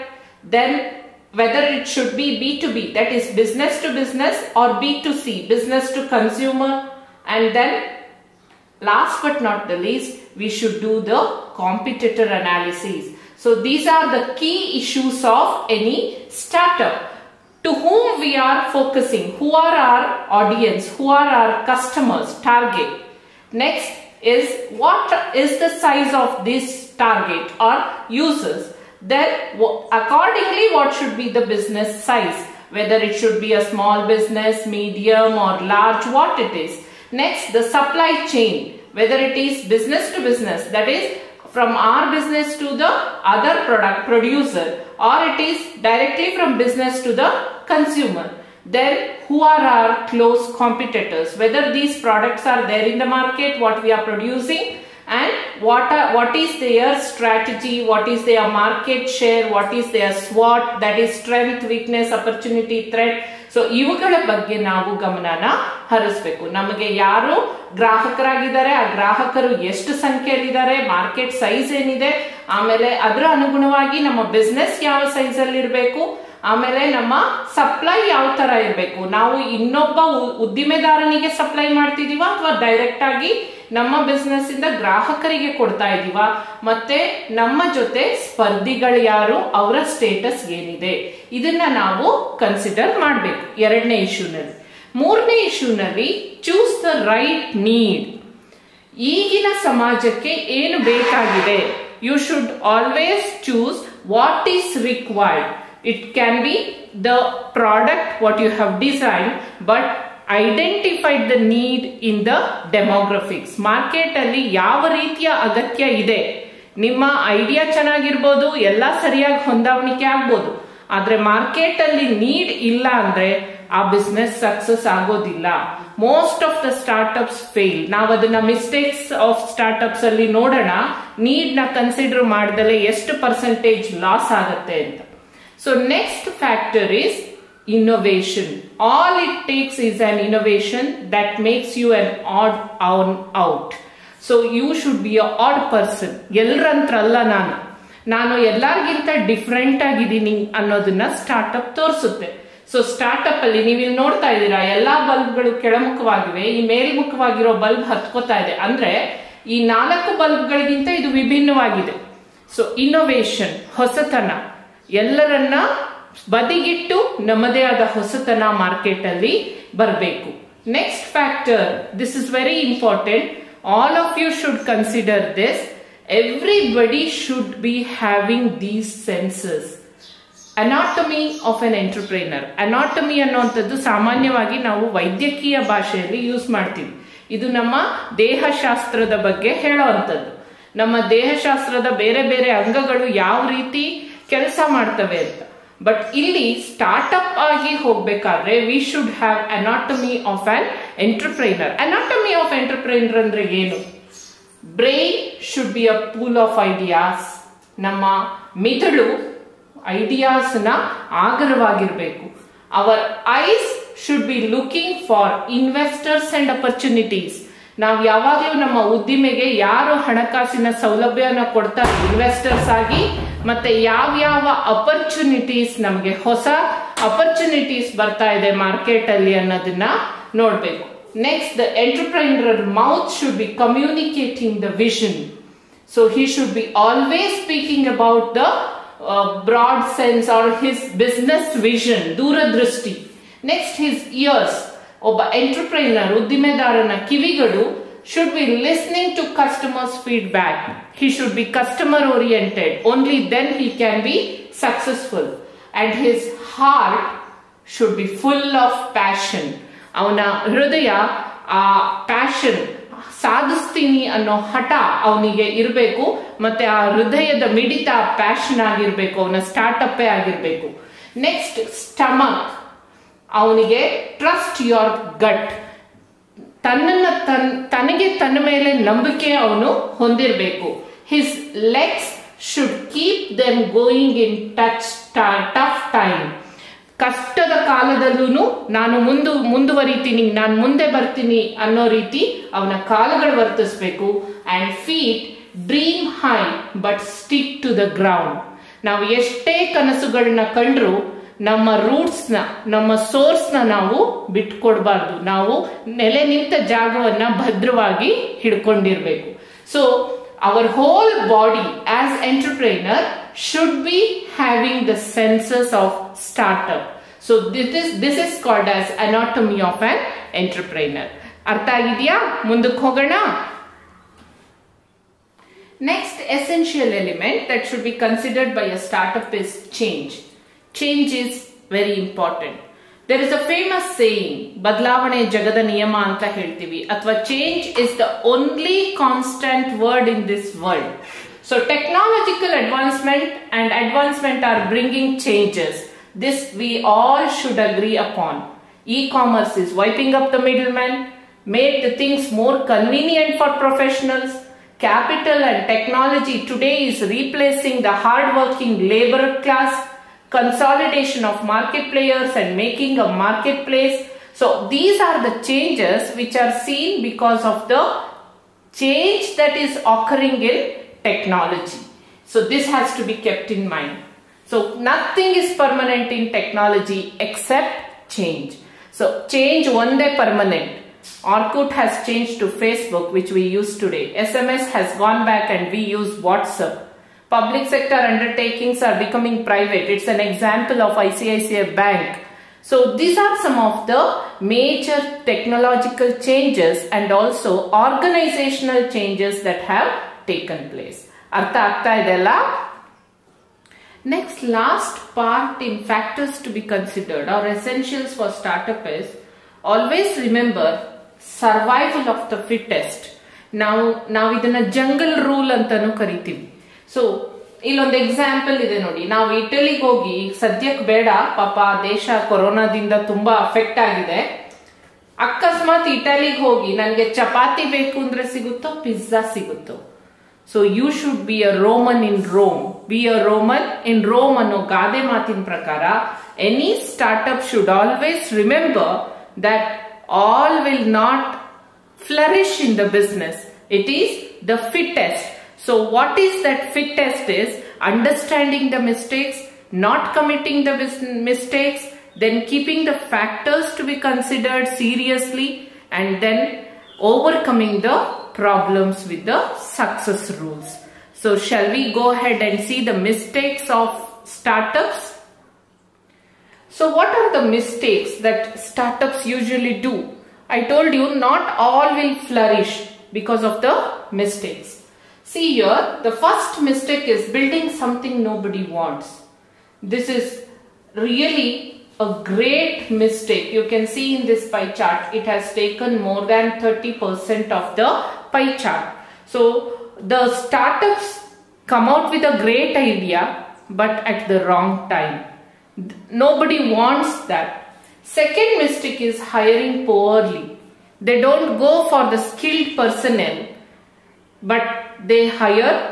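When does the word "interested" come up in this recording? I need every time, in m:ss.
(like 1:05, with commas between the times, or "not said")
not said.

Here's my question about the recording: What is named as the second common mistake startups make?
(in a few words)
hiring poorly.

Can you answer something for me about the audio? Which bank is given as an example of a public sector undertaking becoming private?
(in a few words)
ICICI Bank.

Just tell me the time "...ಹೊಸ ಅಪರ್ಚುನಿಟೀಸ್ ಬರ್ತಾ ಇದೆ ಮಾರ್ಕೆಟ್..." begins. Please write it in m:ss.
3:46.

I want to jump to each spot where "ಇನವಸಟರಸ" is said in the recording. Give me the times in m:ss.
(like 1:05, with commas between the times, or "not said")
3:35, 3:42.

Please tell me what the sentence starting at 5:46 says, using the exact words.
This we all should agree upon.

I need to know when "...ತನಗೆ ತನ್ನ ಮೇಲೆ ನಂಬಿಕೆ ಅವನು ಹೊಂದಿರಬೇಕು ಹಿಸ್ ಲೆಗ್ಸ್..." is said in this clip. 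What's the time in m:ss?
4:37.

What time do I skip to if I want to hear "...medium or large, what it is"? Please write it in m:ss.
0:34.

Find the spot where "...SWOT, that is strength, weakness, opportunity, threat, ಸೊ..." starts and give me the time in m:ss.
1:00.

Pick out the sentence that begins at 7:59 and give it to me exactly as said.
This is really a great mistake.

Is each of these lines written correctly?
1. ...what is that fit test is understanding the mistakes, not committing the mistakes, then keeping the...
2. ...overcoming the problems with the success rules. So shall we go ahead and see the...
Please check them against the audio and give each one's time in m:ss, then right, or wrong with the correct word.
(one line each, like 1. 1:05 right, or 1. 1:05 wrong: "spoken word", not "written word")
1. 7:25 right
2. 7:36 right.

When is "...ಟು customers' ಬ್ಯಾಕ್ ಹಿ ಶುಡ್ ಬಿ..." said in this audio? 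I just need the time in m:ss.
4:09.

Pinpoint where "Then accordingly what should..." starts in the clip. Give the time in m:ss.
0:28.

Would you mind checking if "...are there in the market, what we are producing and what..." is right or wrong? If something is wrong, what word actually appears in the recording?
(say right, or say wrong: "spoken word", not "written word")
right.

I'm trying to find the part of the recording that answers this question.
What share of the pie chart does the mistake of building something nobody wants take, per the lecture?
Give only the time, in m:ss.
8:06.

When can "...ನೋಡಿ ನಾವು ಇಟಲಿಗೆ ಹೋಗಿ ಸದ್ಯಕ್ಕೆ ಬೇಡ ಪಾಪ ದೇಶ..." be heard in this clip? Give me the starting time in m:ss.
6:58.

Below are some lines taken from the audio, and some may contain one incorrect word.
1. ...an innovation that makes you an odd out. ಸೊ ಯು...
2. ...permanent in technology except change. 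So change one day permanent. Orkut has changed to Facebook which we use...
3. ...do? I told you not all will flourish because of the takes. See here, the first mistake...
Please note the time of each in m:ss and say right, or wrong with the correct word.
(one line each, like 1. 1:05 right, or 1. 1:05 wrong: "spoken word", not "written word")
1. 2:19 right
2. 6:15 right
3. 7:49 wrong: "mistakes", not "takes".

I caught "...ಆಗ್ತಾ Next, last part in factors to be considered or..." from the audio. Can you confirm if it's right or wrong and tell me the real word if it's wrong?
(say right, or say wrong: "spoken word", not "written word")
right.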